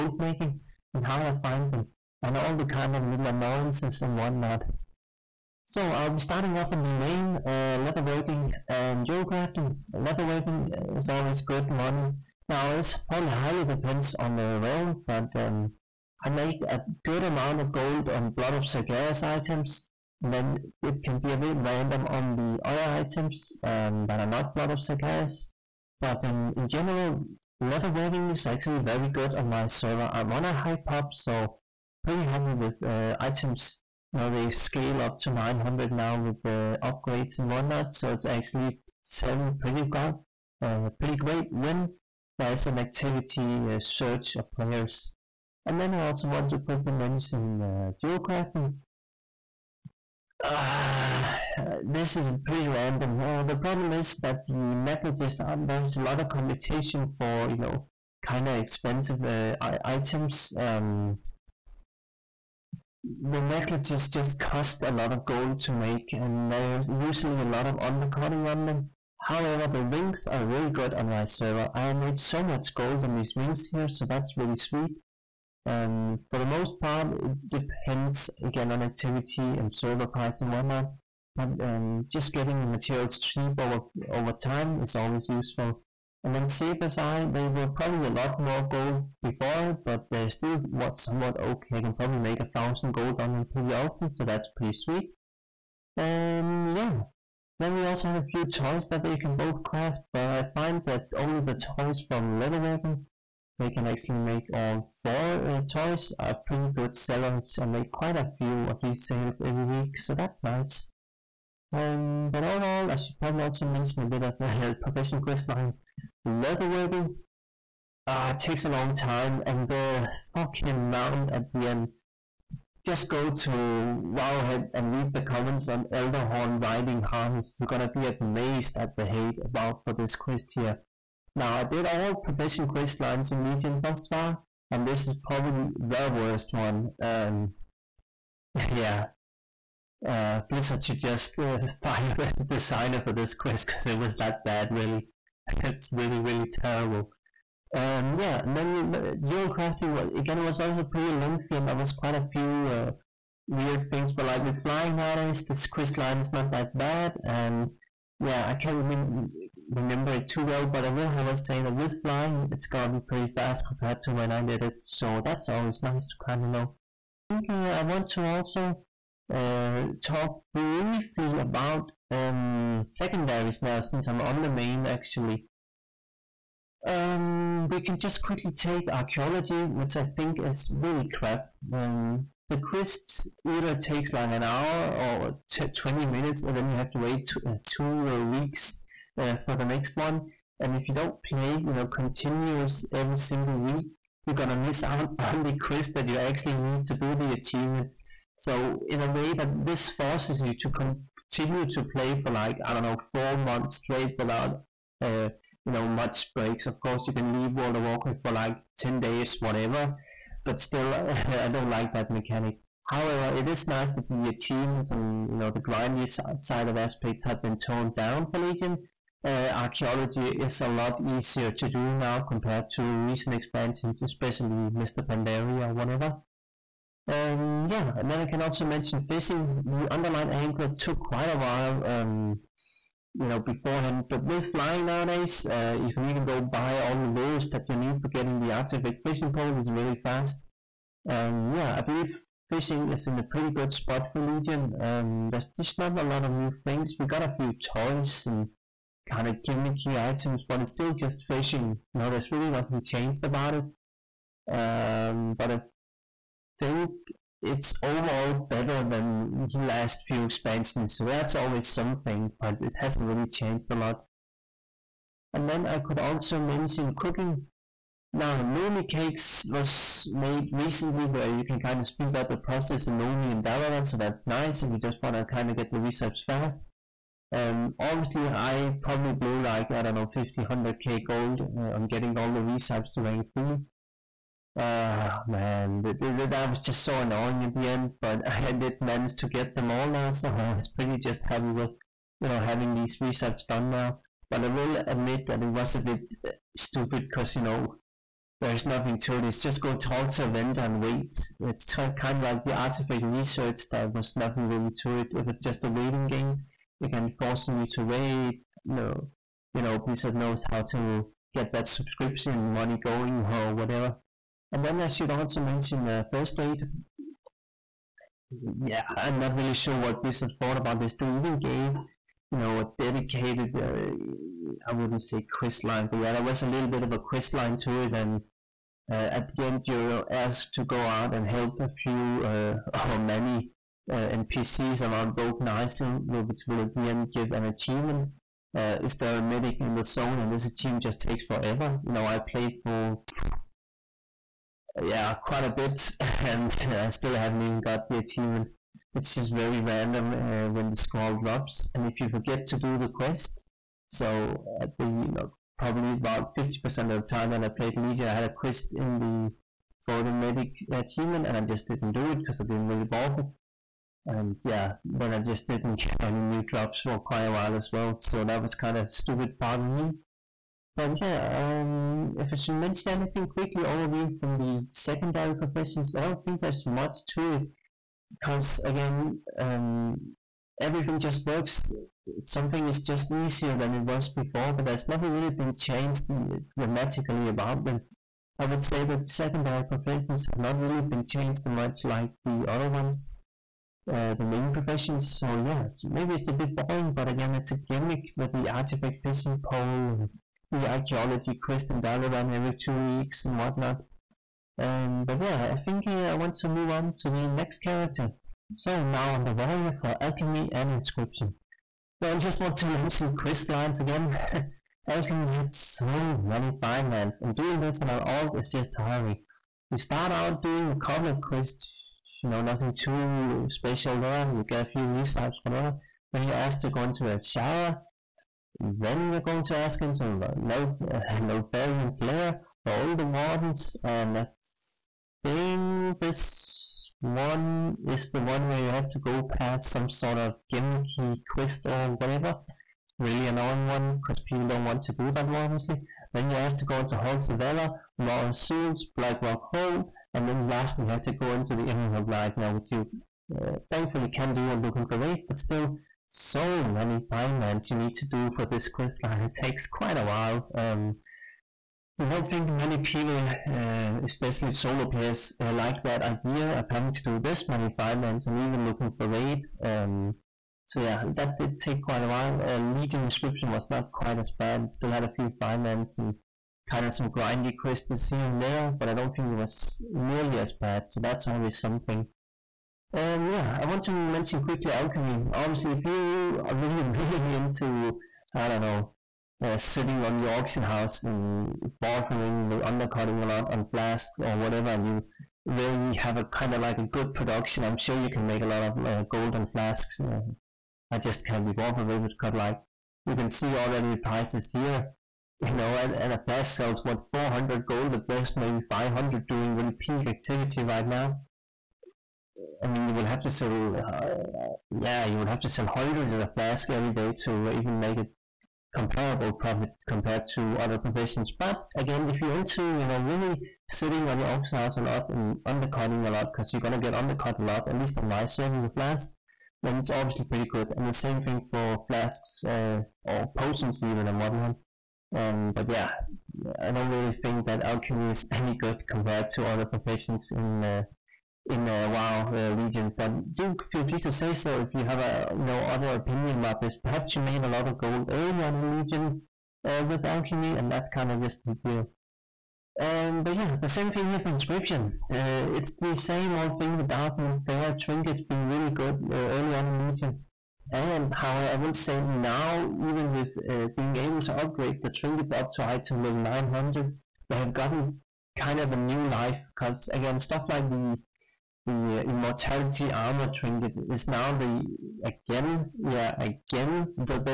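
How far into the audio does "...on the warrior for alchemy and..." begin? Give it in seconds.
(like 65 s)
409 s.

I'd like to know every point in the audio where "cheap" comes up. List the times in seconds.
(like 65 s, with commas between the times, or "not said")
83 s.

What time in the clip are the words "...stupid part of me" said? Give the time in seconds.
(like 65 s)
368 s.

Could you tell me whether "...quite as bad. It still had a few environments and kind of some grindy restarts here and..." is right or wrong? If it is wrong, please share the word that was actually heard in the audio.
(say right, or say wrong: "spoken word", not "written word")
wrong: "quests", not "restarts".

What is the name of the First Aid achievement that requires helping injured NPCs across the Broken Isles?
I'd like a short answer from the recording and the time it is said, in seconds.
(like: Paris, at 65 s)
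Is there a medic in the zone?, at 338 s.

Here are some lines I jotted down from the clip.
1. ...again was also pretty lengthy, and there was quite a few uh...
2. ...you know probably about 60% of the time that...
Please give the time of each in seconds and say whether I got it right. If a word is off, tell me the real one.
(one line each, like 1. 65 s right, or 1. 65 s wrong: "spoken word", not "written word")
1. 150 s right
2. 354 s wrong: "50", not "60".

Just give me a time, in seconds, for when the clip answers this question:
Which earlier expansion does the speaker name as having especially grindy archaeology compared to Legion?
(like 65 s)
224 s.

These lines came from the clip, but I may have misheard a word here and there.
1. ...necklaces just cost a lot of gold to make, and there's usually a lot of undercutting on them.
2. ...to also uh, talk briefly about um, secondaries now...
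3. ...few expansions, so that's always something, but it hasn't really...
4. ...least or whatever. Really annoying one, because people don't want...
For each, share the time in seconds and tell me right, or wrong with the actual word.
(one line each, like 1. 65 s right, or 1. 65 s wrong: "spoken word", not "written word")
1. 63 s right
2. 168 s right
3. 260 s right
4. 441 s wrong: "quest", not "least".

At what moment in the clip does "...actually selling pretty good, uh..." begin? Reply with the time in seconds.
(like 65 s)
38 s.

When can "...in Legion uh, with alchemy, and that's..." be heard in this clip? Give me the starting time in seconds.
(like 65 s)
548 s.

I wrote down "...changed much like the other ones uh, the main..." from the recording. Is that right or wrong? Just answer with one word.
right.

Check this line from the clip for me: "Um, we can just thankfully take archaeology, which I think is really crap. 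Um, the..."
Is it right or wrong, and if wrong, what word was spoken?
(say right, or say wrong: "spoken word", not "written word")
wrong: "quickly", not "thankfully".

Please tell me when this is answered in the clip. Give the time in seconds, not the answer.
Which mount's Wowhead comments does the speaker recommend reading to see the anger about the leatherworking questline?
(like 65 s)
125 s.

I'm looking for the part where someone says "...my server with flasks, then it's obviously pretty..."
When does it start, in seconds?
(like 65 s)
528 s.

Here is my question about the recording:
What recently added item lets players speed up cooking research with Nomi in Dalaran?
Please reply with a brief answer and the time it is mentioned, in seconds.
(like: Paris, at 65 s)
Nomi Cakes, at 268 s.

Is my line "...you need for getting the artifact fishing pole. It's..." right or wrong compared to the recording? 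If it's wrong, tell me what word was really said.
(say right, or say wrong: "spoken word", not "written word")
right.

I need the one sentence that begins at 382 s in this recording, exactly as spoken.
Something is just easier than it was before, but that's never really been changed dramatically about them.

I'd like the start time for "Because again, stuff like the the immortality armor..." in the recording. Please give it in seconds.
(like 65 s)
569 s.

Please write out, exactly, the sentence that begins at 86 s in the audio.
And then Saber's Eye, they were probably a lot more gold before, but they still was somewhat okay.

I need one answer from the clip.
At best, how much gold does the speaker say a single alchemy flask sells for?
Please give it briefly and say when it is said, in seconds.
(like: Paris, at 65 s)
400 gold, at 507 s.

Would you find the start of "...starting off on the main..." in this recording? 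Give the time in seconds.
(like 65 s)
6 s.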